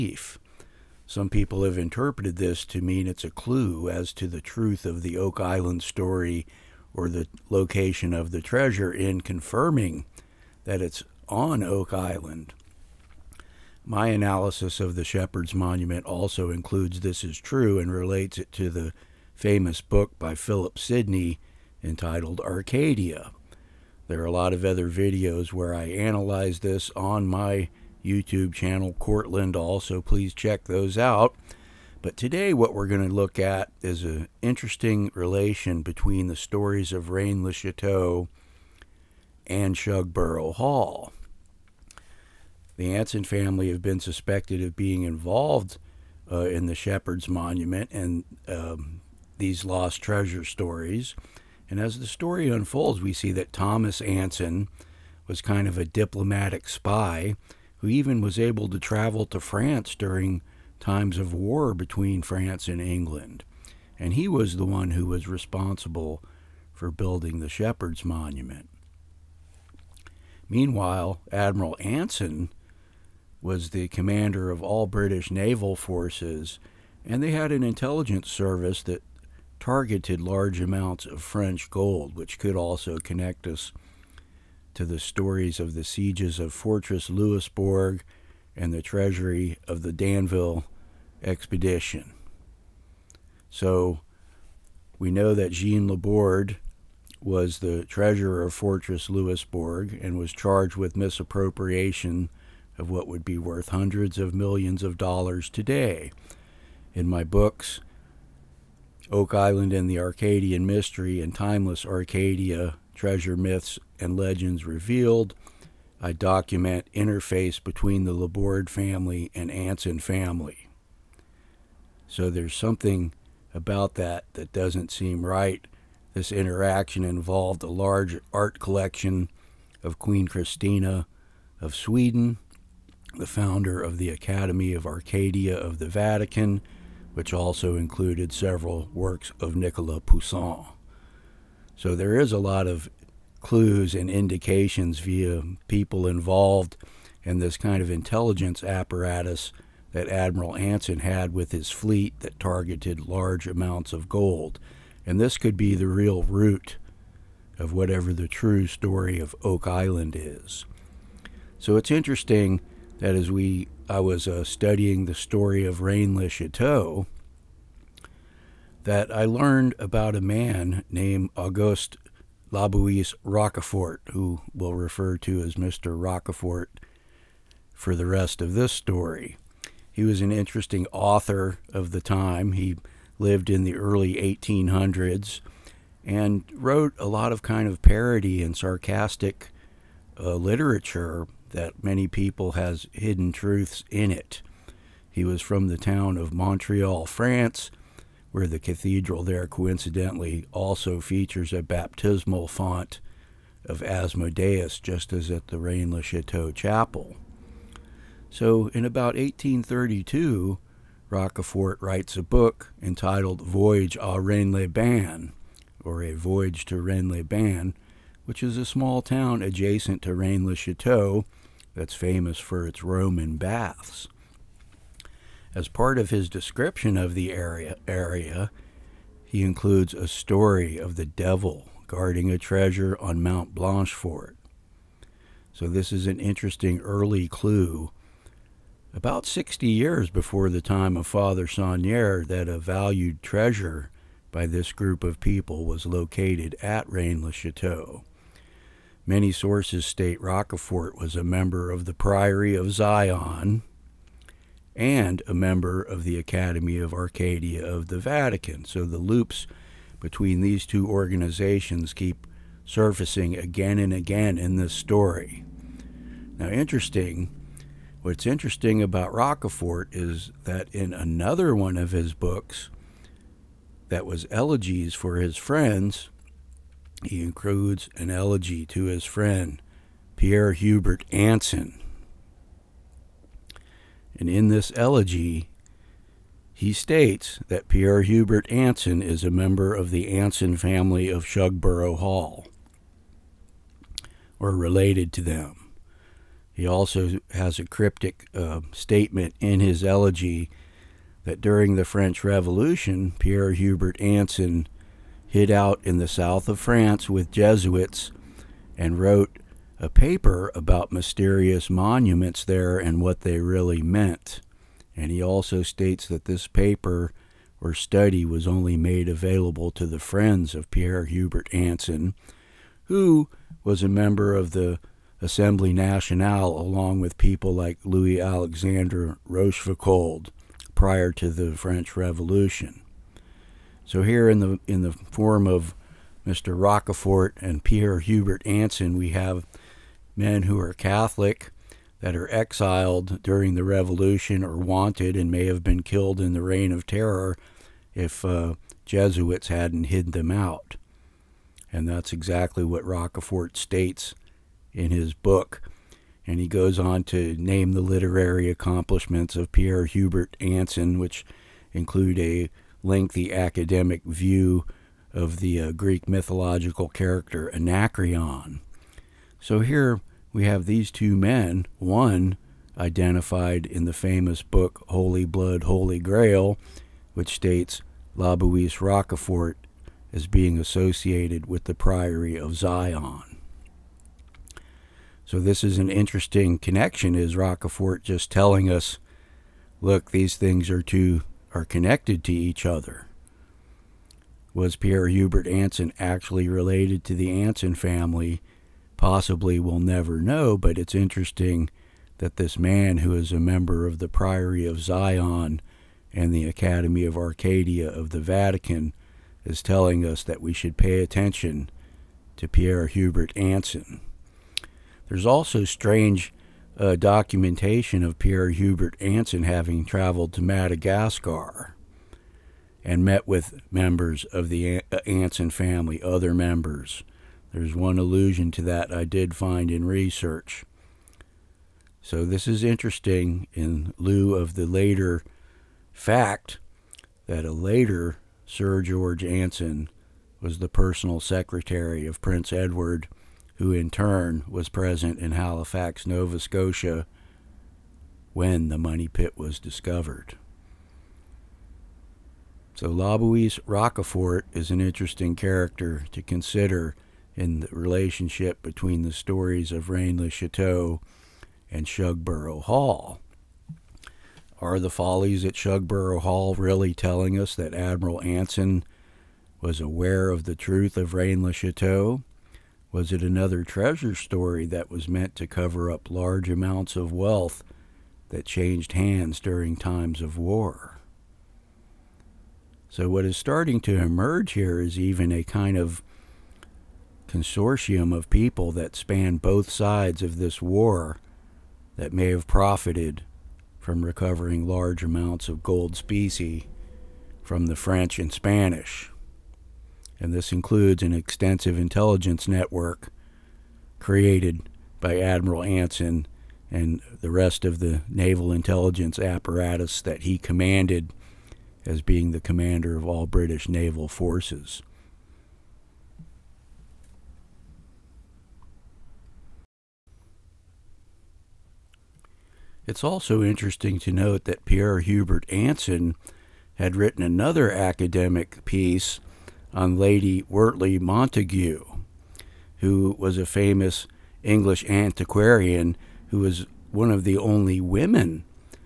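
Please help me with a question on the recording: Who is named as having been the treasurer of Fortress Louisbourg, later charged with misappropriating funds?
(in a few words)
Jean Laborde.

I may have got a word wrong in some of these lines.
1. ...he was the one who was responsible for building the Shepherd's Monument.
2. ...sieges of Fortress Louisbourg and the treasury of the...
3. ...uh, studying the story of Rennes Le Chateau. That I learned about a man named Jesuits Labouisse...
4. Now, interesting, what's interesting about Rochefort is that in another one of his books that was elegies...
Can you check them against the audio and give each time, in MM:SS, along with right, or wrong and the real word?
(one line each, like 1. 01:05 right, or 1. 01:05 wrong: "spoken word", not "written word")
1. 01:04 right
2. 01:25 right
3. 02:44 wrong: "Auguste", not "Jesuits"
4. 04:26 right.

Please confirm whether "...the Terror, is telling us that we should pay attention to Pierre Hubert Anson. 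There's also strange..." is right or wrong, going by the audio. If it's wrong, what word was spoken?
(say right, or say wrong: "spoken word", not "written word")
wrong: "Vatican", not "Terror".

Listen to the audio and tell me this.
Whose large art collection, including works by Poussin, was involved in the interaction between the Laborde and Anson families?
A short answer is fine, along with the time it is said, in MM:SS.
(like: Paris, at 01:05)
Queen Christina of Sweden, at 02:09.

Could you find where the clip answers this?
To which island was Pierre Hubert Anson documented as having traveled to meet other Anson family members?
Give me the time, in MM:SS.
07:00.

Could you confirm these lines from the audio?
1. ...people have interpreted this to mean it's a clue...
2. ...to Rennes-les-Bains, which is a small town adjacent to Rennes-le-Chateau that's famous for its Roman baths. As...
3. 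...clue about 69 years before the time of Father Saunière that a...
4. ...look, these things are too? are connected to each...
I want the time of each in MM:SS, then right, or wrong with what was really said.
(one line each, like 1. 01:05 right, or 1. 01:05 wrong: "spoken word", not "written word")
1. 00:01 right
2. 03:36 right
3. 03:57 wrong: "60", not "69"
4. 06:29 right.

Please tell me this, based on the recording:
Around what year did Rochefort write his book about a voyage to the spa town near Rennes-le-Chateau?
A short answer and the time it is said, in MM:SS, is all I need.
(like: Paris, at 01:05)
1832, at 03:29.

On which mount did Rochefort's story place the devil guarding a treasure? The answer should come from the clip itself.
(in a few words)
Mount Blanchefort.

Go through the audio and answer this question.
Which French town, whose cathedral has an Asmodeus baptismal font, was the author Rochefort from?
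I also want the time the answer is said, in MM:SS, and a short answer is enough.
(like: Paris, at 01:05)
Montreal, at 03:16.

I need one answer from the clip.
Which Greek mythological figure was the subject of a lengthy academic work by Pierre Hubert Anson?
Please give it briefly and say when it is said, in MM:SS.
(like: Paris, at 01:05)
Anacreon, at 06:07.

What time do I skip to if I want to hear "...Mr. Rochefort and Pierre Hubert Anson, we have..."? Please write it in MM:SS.
05:36.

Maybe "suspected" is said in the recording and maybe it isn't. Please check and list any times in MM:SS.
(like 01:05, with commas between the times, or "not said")
00:44.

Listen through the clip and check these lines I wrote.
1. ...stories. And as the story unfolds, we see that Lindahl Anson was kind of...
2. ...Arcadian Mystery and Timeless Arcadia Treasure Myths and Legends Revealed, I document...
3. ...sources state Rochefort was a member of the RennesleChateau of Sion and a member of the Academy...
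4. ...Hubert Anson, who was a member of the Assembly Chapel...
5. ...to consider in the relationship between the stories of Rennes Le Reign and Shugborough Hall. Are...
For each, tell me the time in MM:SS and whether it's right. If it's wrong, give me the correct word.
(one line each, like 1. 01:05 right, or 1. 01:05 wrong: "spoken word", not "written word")
1. 00:50 wrong: "Thomas", not "Lindahl"
2. 01:49 right
3. 04:09 wrong: "Priory", not "RennesleChateau"
4. 05:21 wrong: "Nationale", not "Chapel"
5. 07:36 wrong: "Chateau", not "Reign".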